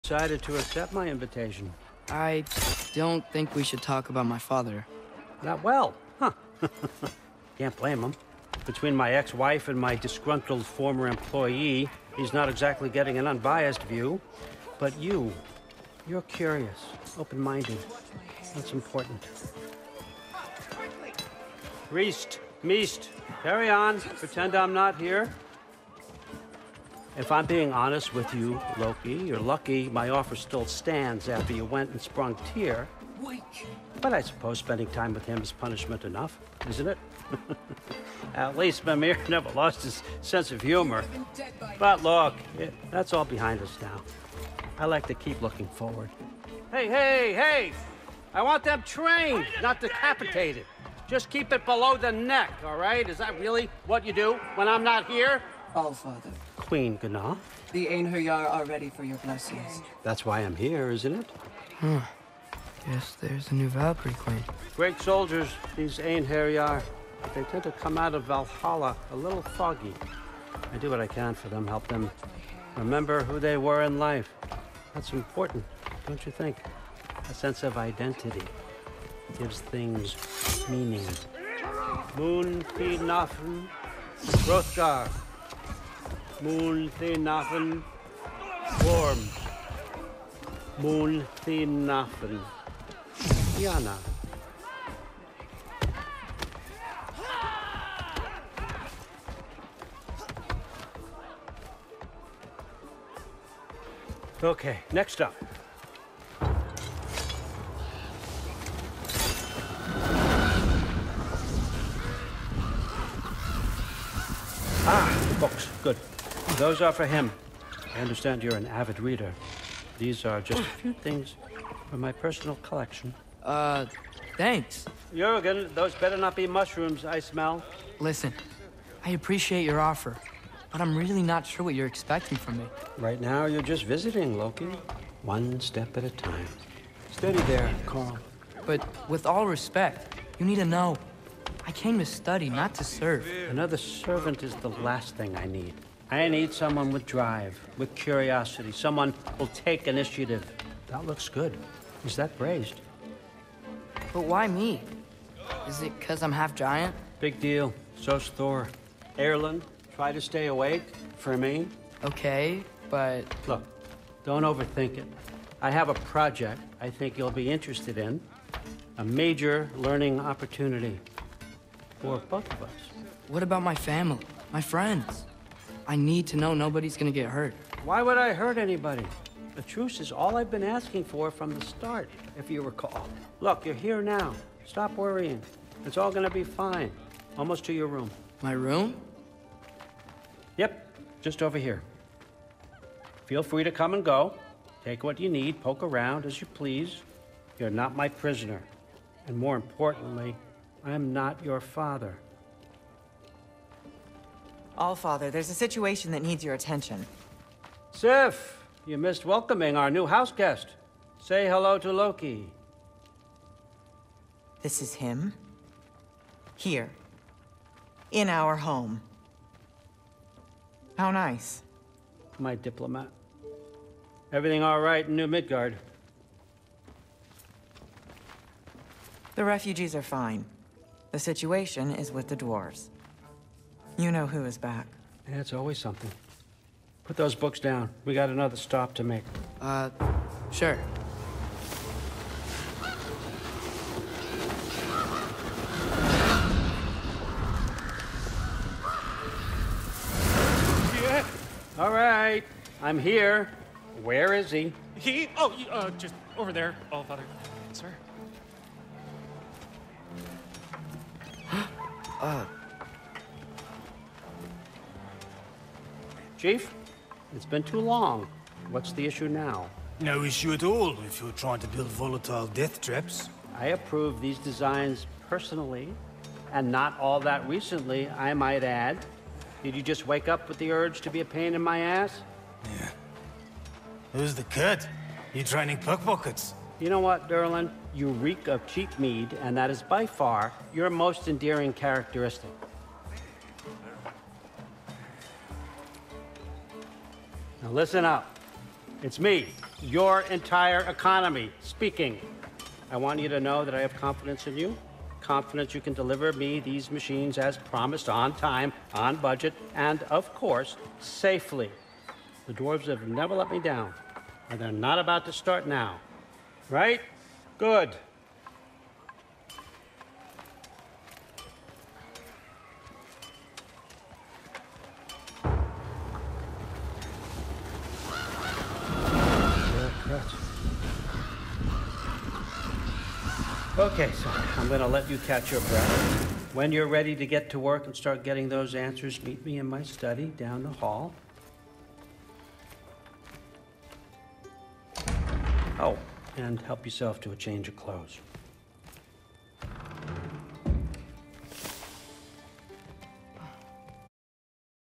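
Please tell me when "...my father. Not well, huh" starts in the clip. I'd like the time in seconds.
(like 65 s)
4 s.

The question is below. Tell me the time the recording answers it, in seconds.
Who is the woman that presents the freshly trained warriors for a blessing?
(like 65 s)
56 s.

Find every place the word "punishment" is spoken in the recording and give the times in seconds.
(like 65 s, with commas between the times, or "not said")
35 s.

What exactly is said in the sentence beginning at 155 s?
Is it because I'm half giant?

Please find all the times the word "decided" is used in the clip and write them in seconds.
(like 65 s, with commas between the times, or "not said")
0 s.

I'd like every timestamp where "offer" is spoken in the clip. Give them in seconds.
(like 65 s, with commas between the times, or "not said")
30 s, 129 s.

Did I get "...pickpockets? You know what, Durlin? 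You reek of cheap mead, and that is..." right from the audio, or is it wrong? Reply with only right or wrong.
right.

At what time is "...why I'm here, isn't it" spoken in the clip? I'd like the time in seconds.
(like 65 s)
60 s.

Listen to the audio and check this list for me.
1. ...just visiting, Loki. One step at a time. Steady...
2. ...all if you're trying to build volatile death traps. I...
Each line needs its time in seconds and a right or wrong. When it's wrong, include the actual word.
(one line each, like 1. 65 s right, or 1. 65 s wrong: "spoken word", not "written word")
1. 133 s right
2. 270 s right.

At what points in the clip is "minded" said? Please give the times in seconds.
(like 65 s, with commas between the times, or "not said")
17 s.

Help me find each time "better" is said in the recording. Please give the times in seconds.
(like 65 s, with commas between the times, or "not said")
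125 s.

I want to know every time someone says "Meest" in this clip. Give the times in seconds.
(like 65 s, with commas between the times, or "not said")
22 s.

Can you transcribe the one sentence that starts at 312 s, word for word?
The dwarves have never let me down, and they're not about to start now.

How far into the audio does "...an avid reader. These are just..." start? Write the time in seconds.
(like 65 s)
118 s.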